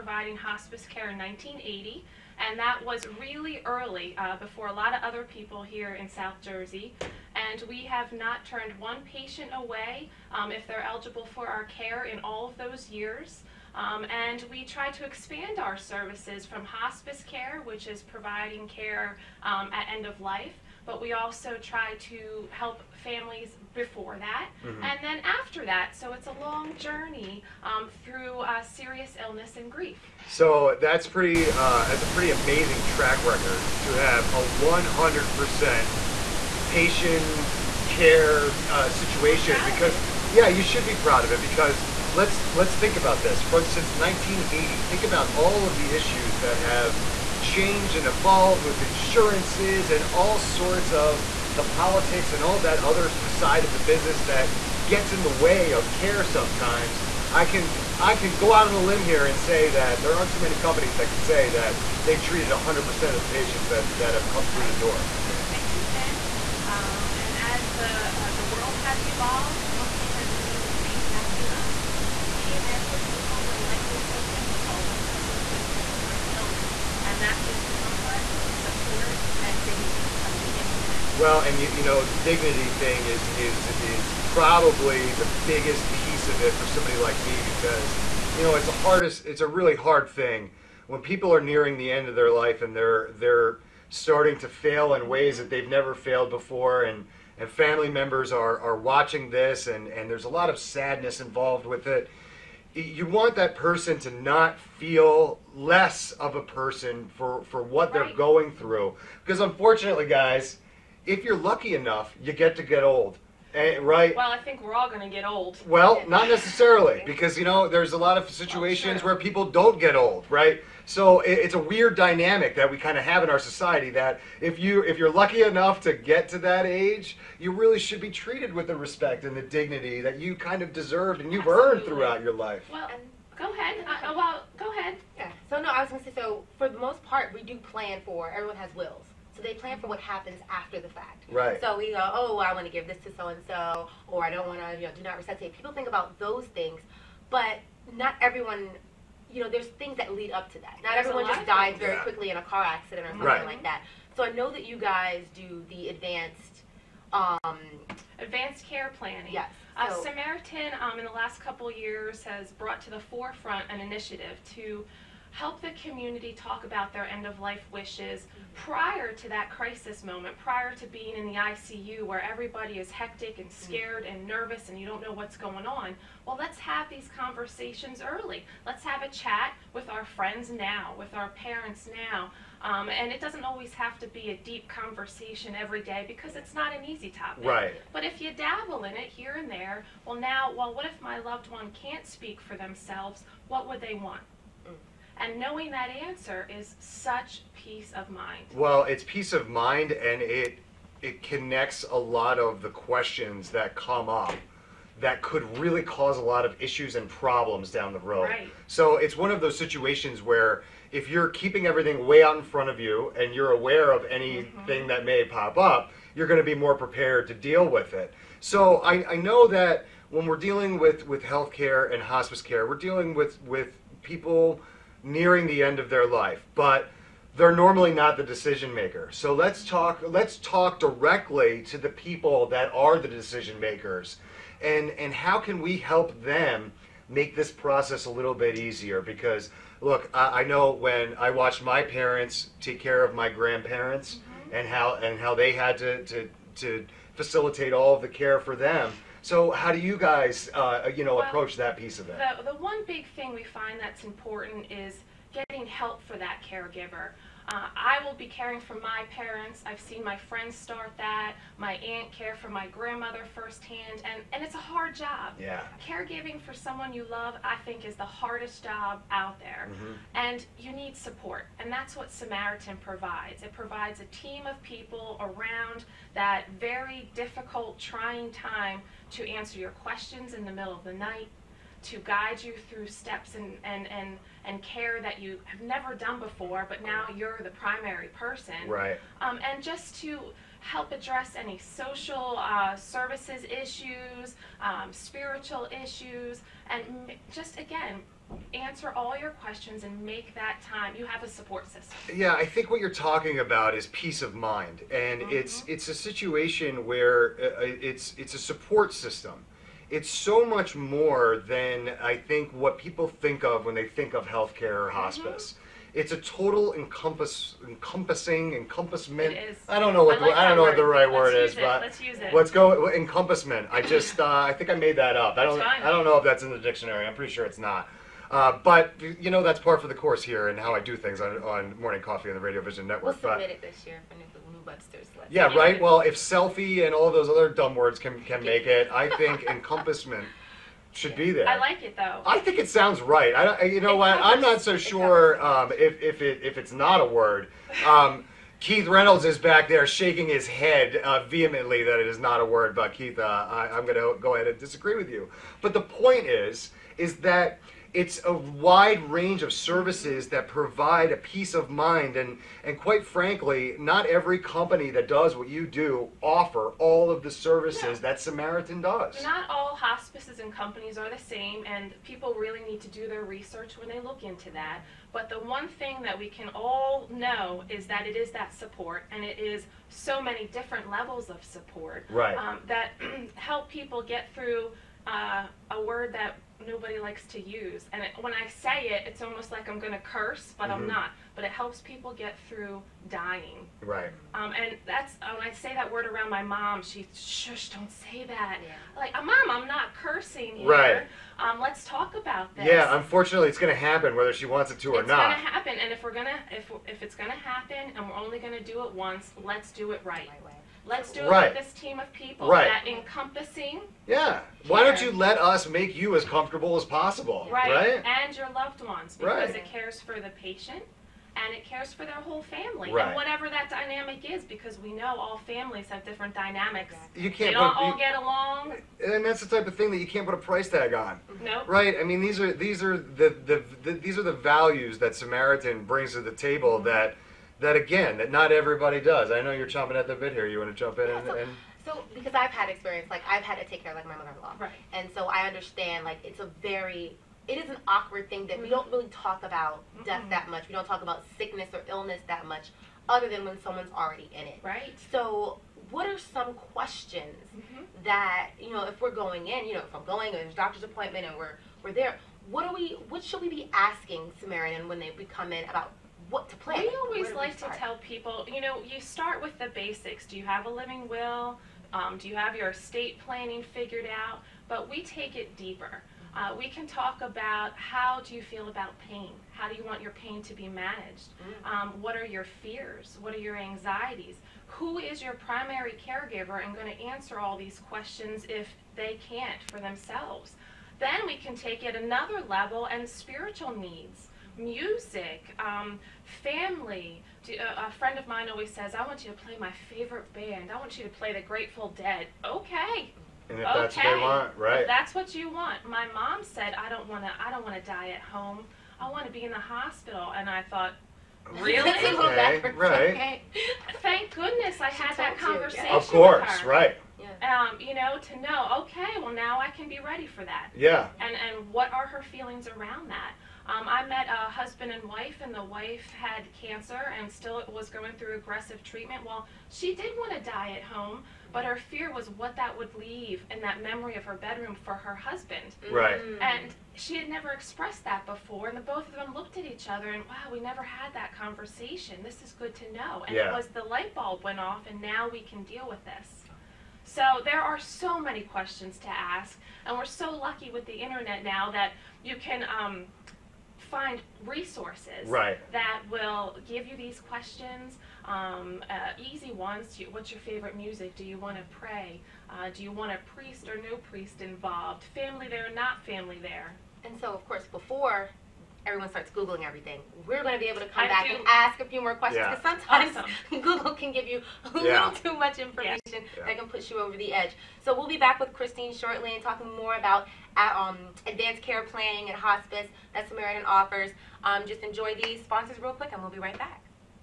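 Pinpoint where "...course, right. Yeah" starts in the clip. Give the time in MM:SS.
08:36.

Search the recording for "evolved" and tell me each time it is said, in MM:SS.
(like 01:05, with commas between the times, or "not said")
00:48, 01:09.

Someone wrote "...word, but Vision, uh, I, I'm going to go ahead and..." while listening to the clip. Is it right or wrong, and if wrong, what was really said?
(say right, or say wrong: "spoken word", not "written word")
wrong: "Keith", not "Vision".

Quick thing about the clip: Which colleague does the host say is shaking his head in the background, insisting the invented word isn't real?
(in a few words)
Keith Reynolds.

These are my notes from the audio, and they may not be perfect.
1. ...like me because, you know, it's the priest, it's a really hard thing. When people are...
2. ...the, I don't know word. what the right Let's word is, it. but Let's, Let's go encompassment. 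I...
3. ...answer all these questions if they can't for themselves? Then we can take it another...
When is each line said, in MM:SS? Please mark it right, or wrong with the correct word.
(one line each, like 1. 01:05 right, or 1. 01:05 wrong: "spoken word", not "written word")
1. 01:26 wrong: "hardest", not "priest"
2. 05:20 right
3. 08:07 right.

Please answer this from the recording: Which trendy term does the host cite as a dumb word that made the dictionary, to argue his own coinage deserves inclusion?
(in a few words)
selfie.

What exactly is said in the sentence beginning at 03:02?
Um, and it doesn't always have to be a deep conversation every day because it's not an easy topic.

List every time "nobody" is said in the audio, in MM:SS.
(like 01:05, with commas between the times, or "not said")
06:26.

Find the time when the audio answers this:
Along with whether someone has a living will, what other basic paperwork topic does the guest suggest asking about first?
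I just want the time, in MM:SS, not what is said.
07:52.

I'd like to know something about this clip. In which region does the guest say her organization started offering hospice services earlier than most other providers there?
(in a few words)
South Jersey.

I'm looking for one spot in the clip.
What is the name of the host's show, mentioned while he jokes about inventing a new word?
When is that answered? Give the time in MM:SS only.
05:31.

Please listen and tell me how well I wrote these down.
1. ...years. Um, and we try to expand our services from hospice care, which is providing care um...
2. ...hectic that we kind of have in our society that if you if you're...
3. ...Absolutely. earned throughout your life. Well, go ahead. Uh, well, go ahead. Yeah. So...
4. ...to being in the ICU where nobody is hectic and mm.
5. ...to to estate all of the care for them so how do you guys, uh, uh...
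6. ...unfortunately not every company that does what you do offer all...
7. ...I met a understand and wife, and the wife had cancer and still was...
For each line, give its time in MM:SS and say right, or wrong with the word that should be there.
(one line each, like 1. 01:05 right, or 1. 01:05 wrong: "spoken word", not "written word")
1. 00:12 right
2. 02:01 wrong: "dynamic", not "hectic"
3. 02:11 right
4. 02:50 wrong: "everybody", not "nobody"
5. 04:06 wrong: "facilitate", not "estate"
6. 06:03 wrong: "frankly", not "unfortunately"
7. 08:43 wrong: "husband", not "understand".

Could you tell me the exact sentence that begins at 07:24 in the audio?
and so I understand like it's a very it is an awkward thing that mm-hmm.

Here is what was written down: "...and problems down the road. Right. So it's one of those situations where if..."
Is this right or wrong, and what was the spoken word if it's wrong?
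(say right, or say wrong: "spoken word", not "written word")
right.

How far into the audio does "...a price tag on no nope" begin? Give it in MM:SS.
07:10.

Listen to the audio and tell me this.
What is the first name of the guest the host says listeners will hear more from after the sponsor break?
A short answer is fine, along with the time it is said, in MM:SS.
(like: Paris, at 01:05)
Christine, at 09:38.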